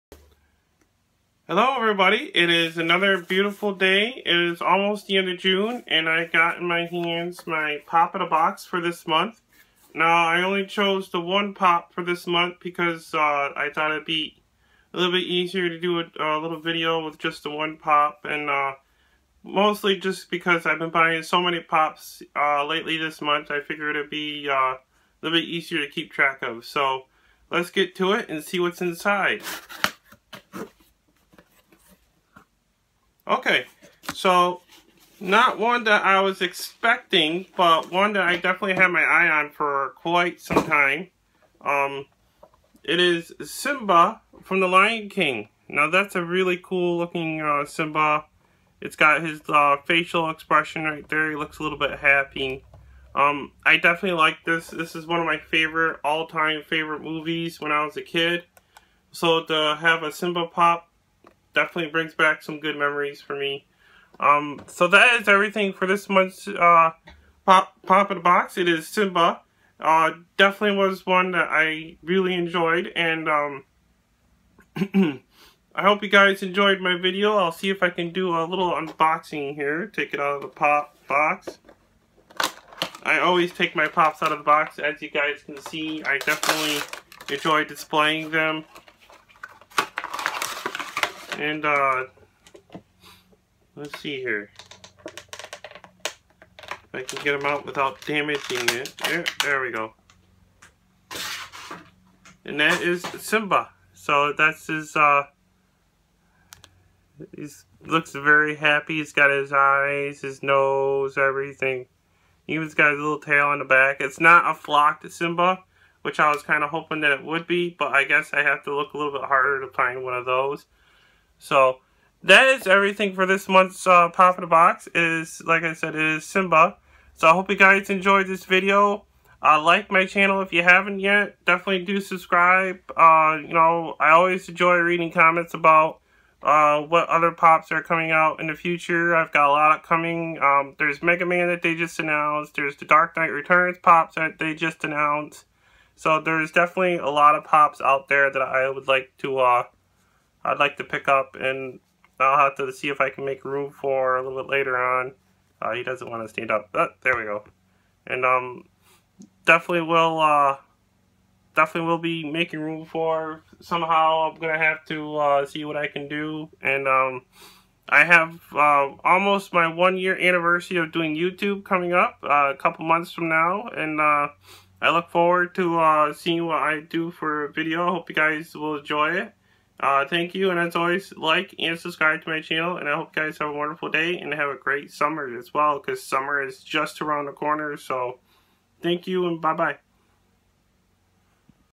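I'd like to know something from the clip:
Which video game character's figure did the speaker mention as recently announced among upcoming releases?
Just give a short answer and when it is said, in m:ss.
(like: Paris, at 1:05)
Mega Man, at 2:21.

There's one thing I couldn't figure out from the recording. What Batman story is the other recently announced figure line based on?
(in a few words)
The Dark Knight Returns.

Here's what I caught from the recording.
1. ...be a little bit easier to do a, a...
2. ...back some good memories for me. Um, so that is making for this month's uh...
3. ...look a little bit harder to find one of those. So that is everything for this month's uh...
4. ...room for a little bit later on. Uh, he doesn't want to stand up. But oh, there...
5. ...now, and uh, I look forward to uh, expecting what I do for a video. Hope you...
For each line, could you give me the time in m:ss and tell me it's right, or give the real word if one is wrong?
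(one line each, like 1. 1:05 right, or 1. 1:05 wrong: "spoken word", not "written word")
1. 0:14 right
2. 1:02 wrong: "everything", not "making"
3. 1:58 right
4. 2:33 right
5. 2:53 wrong: "seeing", not "expecting".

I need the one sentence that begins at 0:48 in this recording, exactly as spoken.
It's got his uh, facial expression right there.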